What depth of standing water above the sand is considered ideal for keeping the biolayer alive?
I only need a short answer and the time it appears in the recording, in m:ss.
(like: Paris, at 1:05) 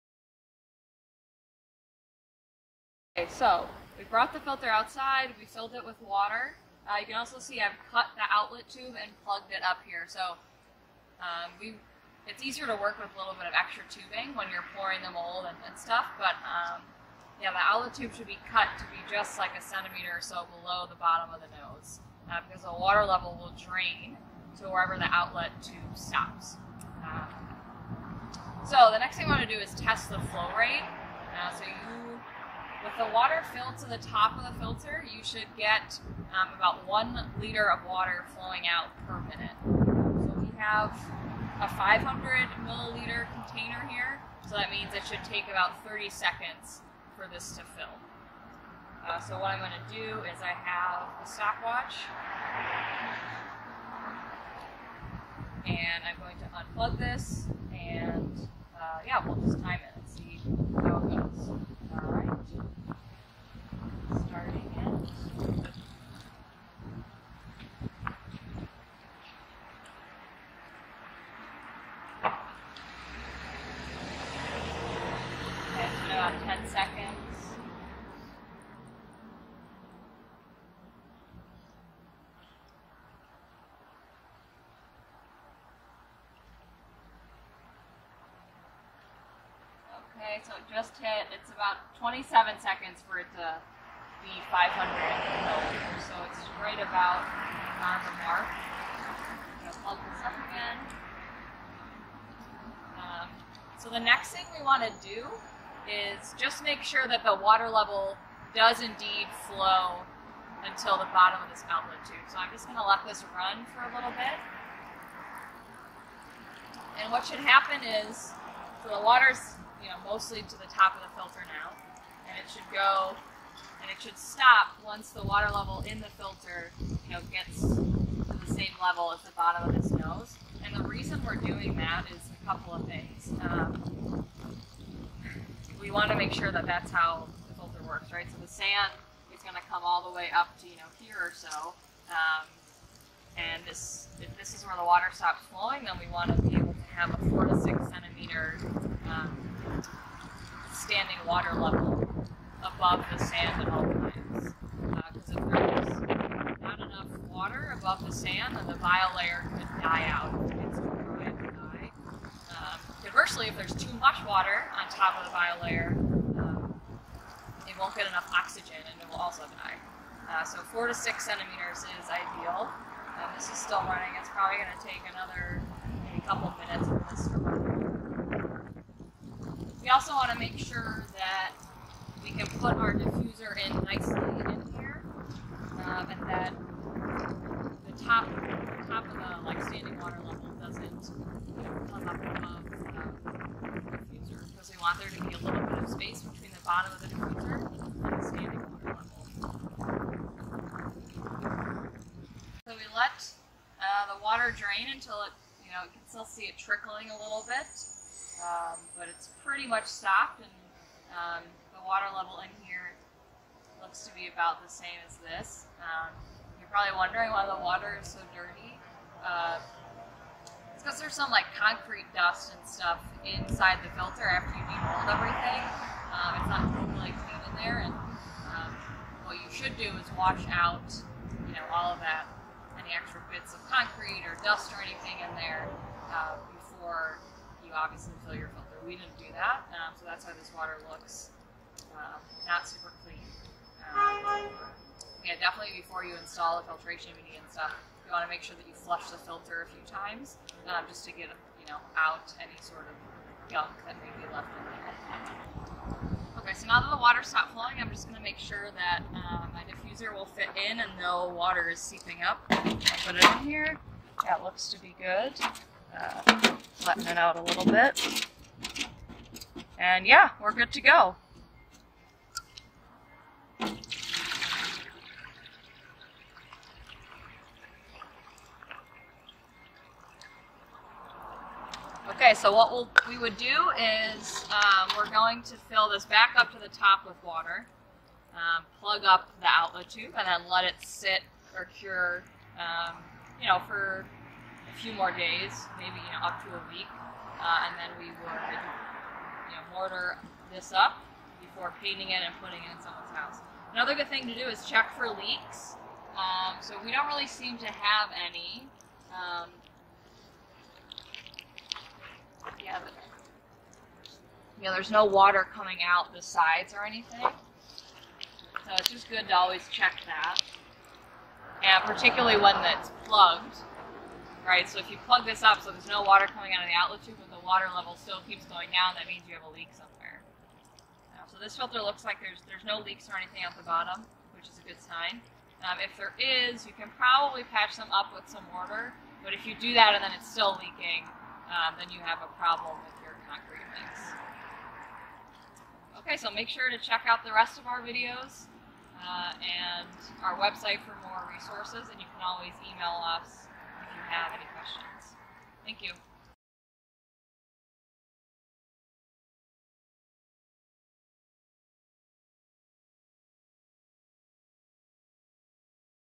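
4 to 6 centimeters, at 2:50.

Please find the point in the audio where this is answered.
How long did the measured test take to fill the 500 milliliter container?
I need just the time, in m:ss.
1:31.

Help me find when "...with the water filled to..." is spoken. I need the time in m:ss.
0:32.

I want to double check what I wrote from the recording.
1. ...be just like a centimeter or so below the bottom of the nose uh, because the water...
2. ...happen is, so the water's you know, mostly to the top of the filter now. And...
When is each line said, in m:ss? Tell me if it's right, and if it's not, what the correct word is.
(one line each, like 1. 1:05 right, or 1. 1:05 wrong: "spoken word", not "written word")
1. 0:18 right
2. 1:57 right.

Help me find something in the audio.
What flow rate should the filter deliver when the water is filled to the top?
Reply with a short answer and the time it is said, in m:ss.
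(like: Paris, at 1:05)
1 liter per minute, at 0:36.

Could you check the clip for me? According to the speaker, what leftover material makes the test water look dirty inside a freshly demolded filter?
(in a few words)
concrete dust.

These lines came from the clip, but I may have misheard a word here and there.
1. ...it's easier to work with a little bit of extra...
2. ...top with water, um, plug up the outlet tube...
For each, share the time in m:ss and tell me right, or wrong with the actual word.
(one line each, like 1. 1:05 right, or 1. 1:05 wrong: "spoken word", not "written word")
1. 0:12 right
2. 4:46 right.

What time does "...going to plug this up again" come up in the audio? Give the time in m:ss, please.
1:39.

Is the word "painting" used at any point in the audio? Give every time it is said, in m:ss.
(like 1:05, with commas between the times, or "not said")
5:01.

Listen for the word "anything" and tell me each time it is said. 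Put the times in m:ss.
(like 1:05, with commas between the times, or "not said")
3:54, 5:16, 5:33.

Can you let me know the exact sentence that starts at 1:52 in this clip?
So I'm just going to let this run for a little bit.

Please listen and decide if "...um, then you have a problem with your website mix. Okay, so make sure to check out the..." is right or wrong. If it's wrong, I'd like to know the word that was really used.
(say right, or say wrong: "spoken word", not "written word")
wrong: "concrete", not "website".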